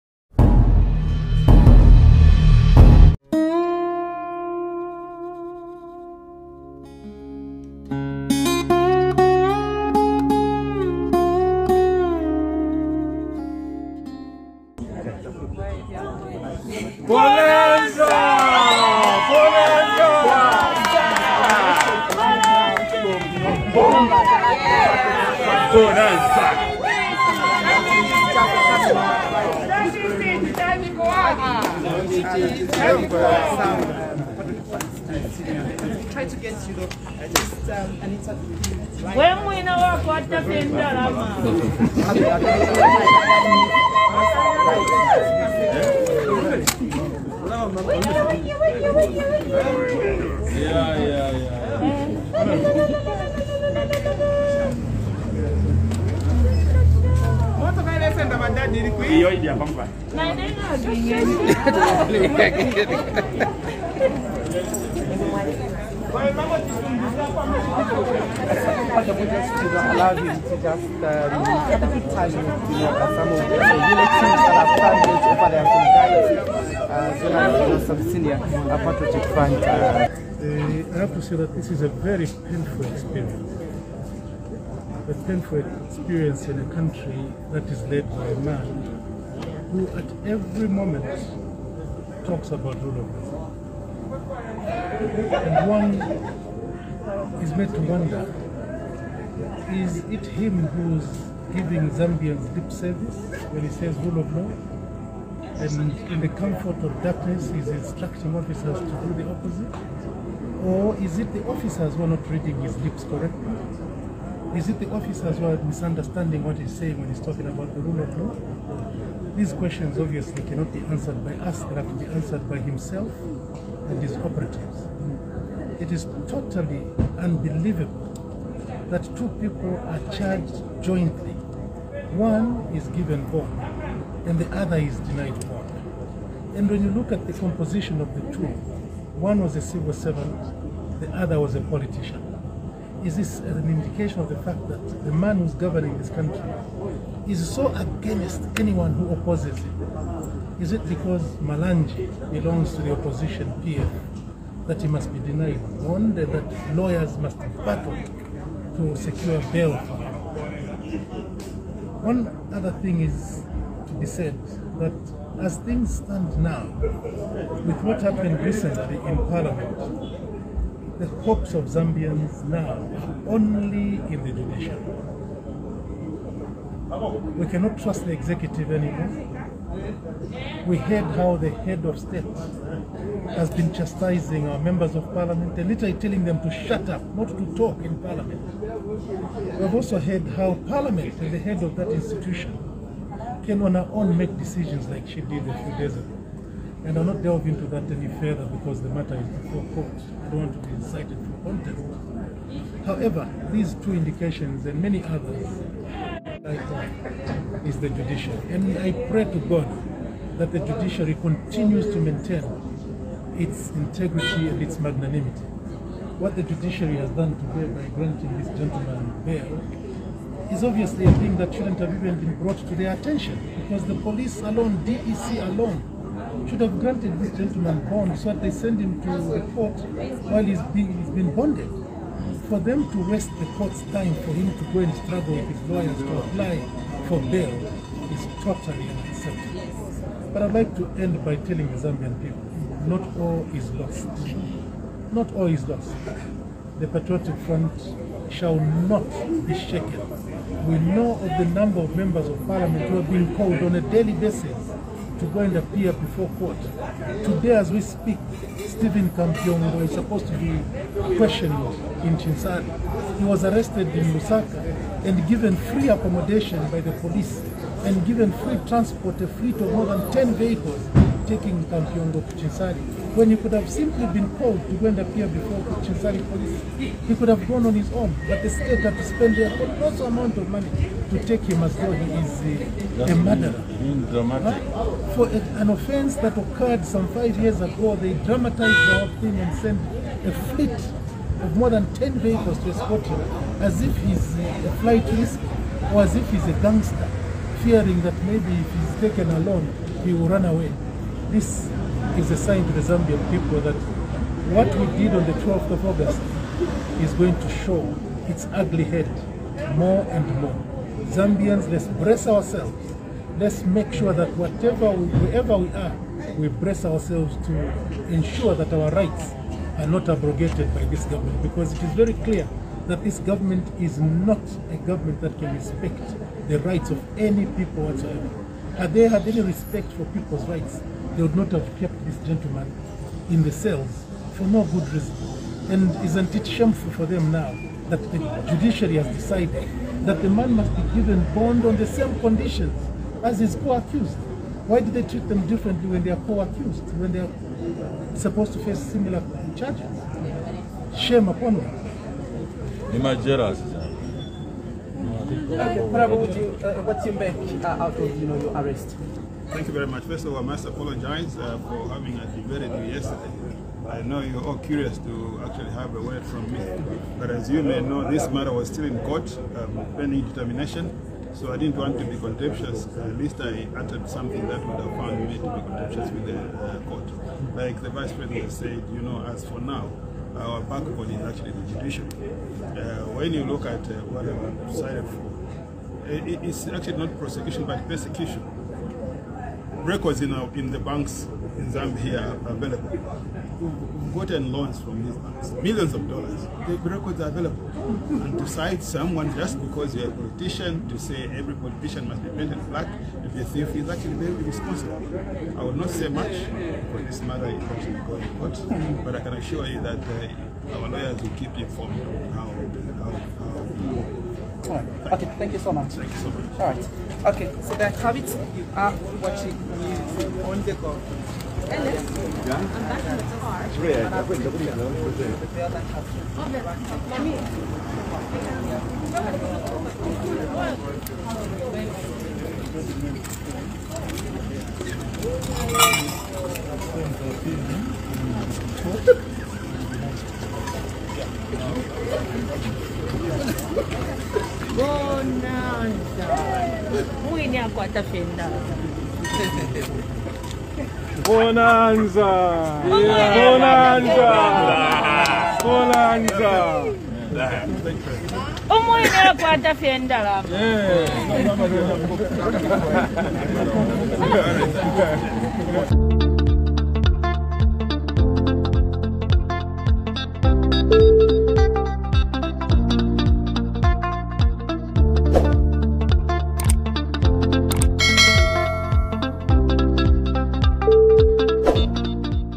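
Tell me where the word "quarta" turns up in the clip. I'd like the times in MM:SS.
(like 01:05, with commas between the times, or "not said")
07:27, 07:39.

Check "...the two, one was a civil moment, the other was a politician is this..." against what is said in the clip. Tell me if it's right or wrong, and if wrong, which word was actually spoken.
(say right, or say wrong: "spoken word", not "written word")
wrong: "servant", not "moment".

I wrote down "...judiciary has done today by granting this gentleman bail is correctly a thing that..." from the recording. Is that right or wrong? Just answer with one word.
wrong.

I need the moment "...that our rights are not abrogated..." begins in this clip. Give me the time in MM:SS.
05:18.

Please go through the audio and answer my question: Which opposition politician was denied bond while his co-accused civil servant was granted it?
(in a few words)
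Malanji.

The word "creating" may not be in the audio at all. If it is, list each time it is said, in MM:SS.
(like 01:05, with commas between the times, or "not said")
not said.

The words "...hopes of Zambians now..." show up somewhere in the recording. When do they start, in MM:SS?
02:51.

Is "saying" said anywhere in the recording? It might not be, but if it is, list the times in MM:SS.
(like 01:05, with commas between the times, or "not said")
01:56.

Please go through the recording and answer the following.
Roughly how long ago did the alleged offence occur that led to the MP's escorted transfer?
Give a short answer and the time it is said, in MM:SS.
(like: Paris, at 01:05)
5 years, at 04:47.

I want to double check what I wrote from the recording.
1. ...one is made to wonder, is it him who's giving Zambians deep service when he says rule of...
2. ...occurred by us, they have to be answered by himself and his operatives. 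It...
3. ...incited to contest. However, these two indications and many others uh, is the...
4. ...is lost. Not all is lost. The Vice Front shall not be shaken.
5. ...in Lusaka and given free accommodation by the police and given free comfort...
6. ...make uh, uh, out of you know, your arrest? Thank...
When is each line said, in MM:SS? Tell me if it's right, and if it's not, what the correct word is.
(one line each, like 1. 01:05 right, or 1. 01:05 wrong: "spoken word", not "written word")
1. 01:35 right
2. 02:00 wrong: "answered", not "occurred"
3. 03:20 right
4. 04:03 wrong: "Patriotic", not "Vice"
5. 04:23 wrong: "transport", not "comfort"
6. 05:57 right.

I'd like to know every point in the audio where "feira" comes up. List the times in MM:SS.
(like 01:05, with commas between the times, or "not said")
07:27, 07:39.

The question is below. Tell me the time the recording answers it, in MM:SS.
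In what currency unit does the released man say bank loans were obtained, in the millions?
06:36.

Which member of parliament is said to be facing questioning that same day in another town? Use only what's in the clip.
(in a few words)
Stephen Kampyongo.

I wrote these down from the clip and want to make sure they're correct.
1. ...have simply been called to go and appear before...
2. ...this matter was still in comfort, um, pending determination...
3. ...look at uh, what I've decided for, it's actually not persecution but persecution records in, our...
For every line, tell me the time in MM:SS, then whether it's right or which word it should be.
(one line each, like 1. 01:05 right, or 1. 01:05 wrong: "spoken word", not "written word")
1. 04:33 right
2. 06:08 wrong: "court", not "comfort"
3. 06:23 wrong: "prosecution", not "persecution".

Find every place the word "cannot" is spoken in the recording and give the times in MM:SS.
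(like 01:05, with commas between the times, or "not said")
02:00, 02:57.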